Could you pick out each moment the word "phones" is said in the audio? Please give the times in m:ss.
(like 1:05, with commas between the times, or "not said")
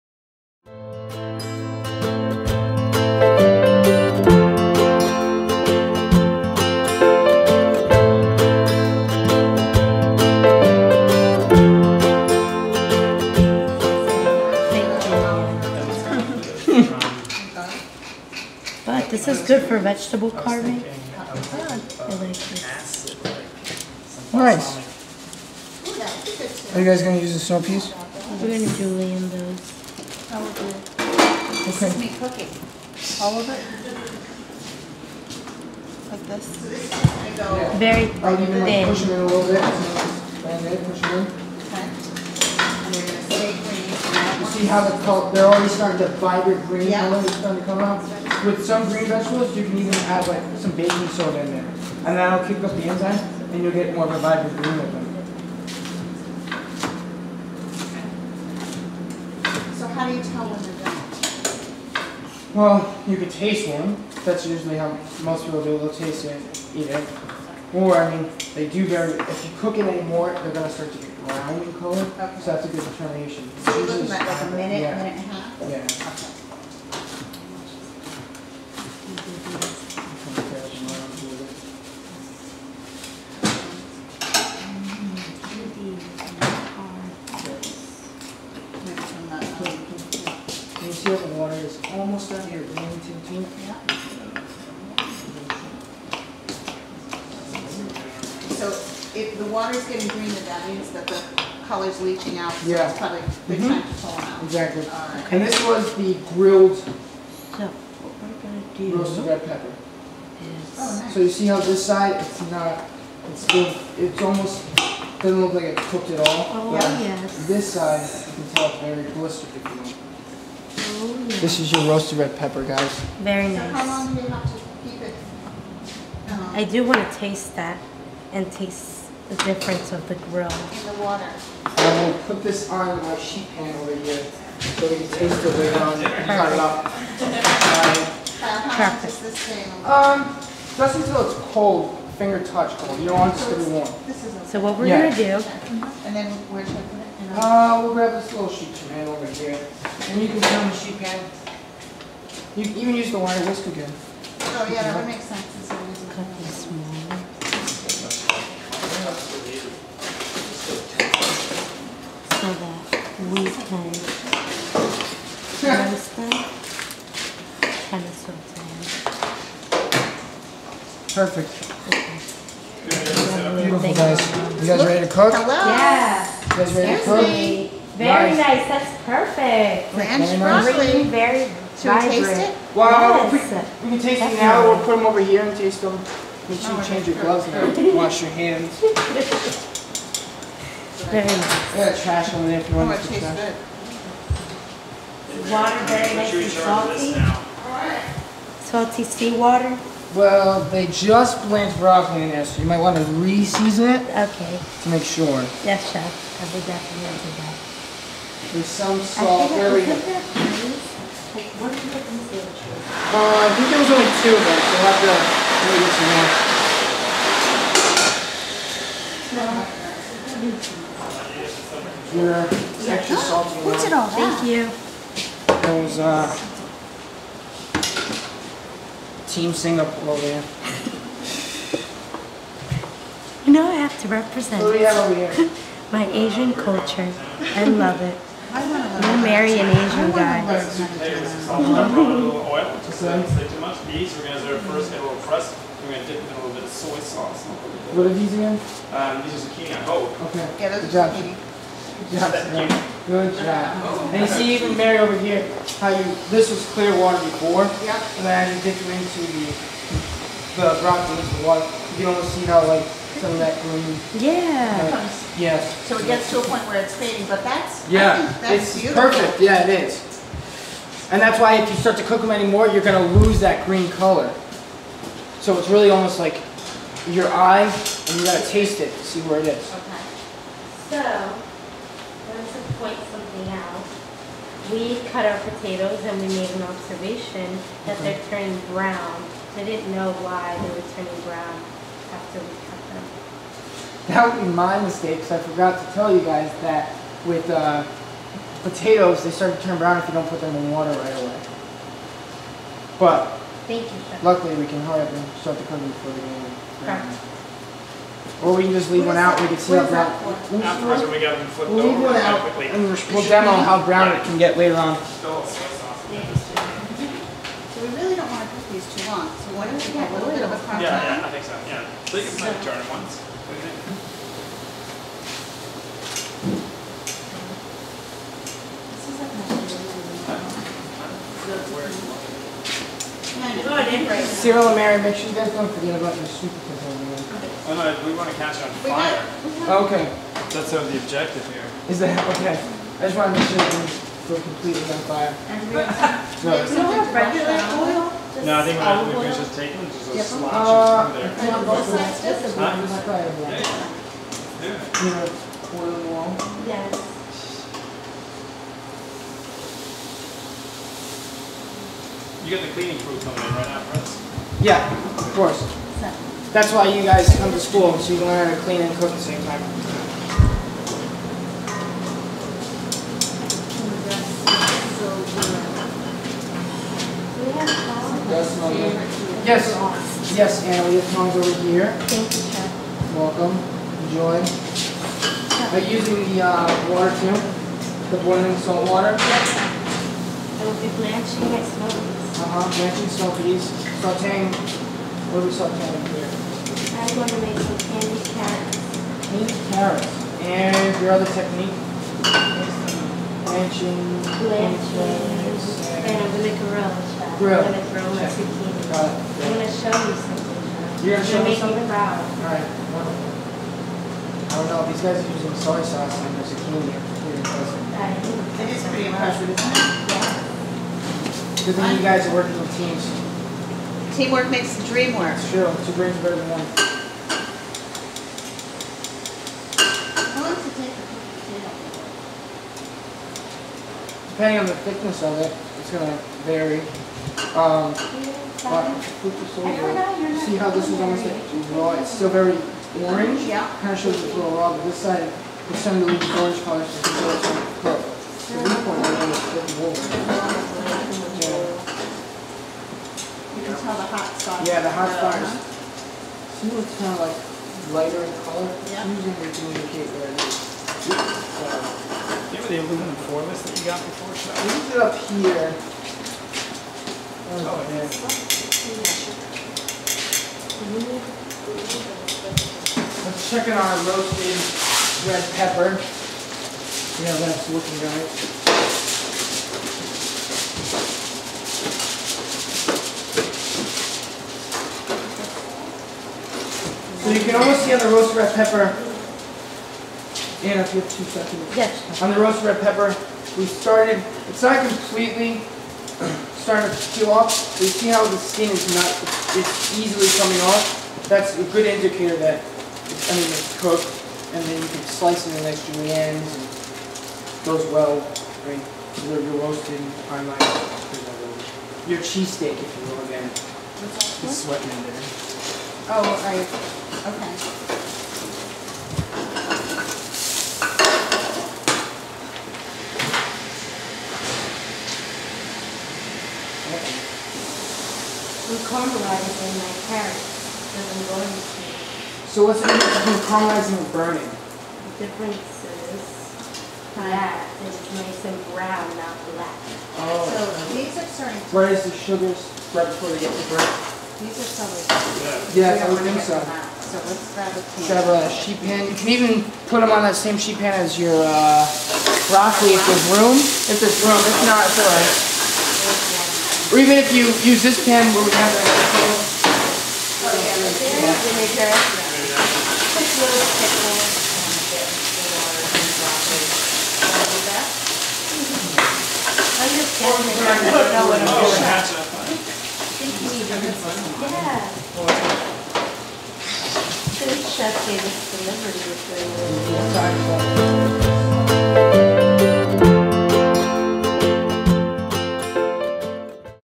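6:21.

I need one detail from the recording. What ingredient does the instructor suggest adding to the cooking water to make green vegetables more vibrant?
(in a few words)
baking soda.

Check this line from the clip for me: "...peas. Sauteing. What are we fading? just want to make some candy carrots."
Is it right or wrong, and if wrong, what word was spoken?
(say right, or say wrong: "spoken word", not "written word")
wrong: "sauteing", not "fading".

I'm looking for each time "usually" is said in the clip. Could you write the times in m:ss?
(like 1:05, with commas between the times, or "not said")
1:04, 7:39.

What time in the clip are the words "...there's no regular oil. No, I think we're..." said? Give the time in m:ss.
5:46.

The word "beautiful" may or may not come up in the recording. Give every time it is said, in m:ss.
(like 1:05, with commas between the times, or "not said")
2:53, 4:28.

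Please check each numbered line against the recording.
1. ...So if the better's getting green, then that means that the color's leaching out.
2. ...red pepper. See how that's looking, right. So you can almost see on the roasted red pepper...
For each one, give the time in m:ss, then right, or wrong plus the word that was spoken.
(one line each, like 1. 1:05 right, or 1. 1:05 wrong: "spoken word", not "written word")
1. 1:38 wrong: "water", not "better"
2. 7:55 right.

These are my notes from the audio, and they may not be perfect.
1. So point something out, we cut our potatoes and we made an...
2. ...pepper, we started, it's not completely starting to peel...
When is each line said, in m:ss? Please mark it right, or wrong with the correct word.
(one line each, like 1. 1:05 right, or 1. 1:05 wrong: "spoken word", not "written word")
1. 4:41 right
2. 8:12 right.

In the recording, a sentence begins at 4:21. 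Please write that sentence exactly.
You almost see how like some of that green.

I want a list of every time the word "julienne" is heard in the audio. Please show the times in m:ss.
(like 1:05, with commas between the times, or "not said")
0:28, 8:25.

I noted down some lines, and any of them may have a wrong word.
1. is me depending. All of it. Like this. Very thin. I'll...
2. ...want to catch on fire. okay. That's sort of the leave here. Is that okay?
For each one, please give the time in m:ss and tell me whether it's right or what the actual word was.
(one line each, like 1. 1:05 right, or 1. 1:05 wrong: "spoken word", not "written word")
1. 0:31 wrong: "cooking", not "depending"
2. 5:38 wrong: "objective", not "leave".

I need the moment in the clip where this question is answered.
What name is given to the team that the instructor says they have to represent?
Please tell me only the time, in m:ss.
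3:49.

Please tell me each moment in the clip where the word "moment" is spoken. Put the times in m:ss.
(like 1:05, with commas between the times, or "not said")
not said.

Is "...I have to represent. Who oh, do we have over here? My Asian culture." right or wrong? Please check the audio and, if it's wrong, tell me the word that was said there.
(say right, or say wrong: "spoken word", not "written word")
right.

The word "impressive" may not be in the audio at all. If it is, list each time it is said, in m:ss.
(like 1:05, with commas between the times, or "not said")
6:59.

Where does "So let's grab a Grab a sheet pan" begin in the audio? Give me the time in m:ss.
9:06.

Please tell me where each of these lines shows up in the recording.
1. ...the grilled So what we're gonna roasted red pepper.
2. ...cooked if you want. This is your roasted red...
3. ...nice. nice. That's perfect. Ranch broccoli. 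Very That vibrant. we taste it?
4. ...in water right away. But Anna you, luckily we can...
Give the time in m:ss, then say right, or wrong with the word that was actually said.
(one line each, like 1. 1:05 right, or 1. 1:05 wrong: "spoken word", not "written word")
1. 1:45 right
2. 1:59 wrong: "blistered", not "cooked"
3. 2:58 wrong: "Should", not "That"
4. 5:00 wrong: "Thank", not "Anna".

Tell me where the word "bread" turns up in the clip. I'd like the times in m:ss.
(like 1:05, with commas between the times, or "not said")
9:03.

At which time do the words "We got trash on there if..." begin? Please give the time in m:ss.
3:11.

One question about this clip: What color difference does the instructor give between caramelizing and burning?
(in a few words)
brown, not black.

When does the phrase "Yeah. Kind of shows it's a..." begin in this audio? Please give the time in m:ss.
7:23.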